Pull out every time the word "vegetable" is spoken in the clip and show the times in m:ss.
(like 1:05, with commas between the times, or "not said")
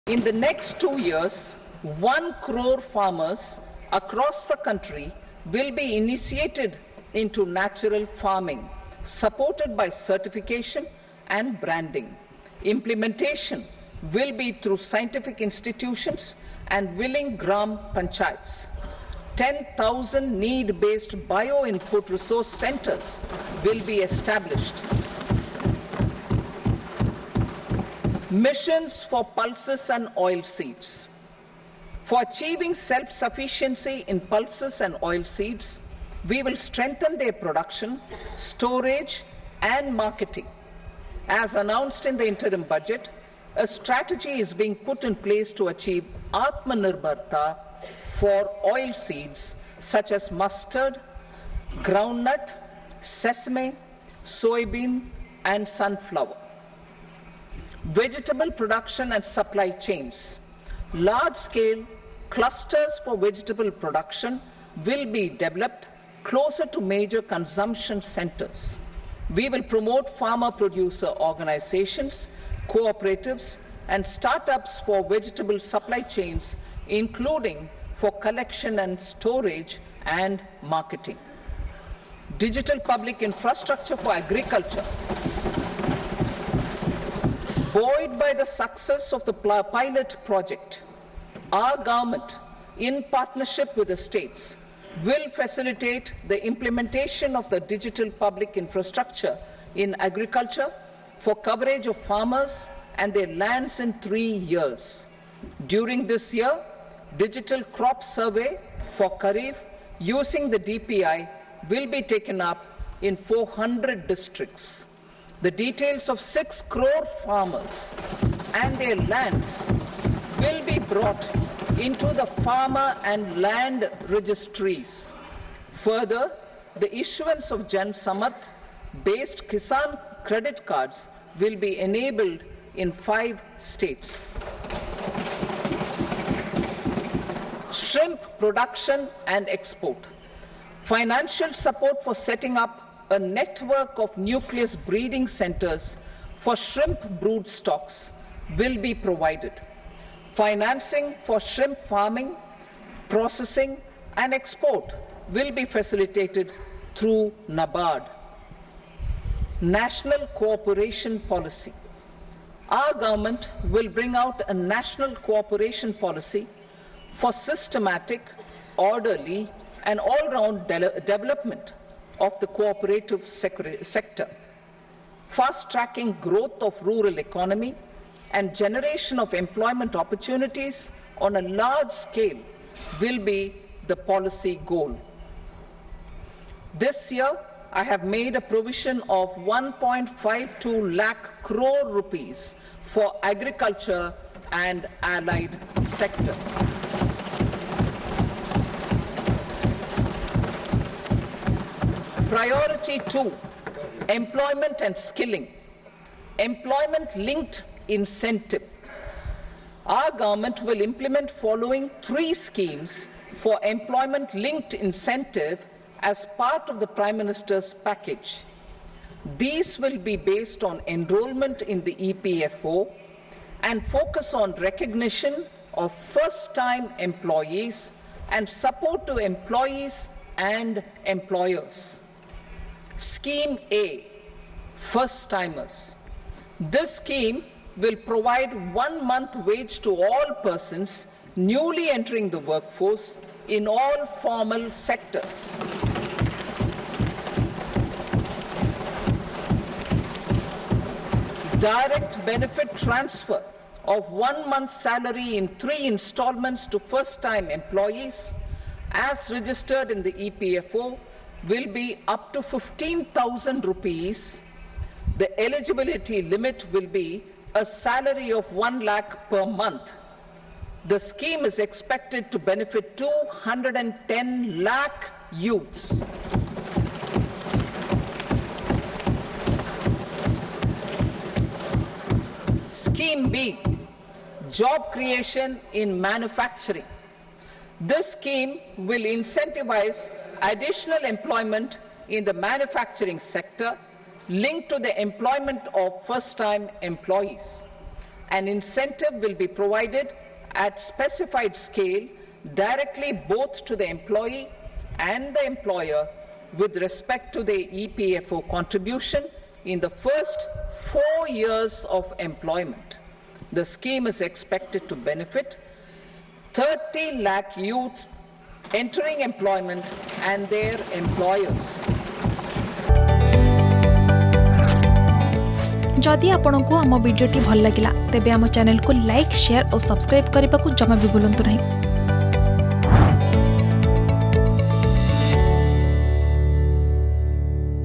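0:57, 1:03, 1:15.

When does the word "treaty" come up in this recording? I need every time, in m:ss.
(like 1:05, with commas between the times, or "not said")
not said.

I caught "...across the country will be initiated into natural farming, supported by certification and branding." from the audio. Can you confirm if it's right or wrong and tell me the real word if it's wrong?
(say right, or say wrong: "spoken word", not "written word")
right.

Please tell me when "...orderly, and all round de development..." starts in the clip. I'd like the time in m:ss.
2:48.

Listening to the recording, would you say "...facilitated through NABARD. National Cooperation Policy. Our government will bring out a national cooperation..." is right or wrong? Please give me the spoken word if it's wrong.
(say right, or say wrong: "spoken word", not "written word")
right.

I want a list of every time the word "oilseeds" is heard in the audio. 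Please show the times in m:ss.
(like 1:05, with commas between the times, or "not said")
0:30, 0:34, 0:48.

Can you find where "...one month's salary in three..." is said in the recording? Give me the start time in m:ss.
4:14.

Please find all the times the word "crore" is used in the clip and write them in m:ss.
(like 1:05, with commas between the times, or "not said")
0:02, 1:56, 3:11.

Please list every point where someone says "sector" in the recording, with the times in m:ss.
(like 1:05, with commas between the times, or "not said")
2:53, 3:15, 4:04, 4:53.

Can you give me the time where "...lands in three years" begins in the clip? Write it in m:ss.
1:43.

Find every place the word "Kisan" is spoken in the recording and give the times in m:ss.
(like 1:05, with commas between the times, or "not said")
2:09.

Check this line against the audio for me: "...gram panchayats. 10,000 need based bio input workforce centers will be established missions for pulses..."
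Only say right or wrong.
wrong.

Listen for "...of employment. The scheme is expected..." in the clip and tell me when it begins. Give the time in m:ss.
5:11.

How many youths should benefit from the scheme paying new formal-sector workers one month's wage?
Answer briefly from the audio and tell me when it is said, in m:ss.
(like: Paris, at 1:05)
210 lakh, at 4:32.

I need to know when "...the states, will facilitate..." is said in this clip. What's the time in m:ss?
1:33.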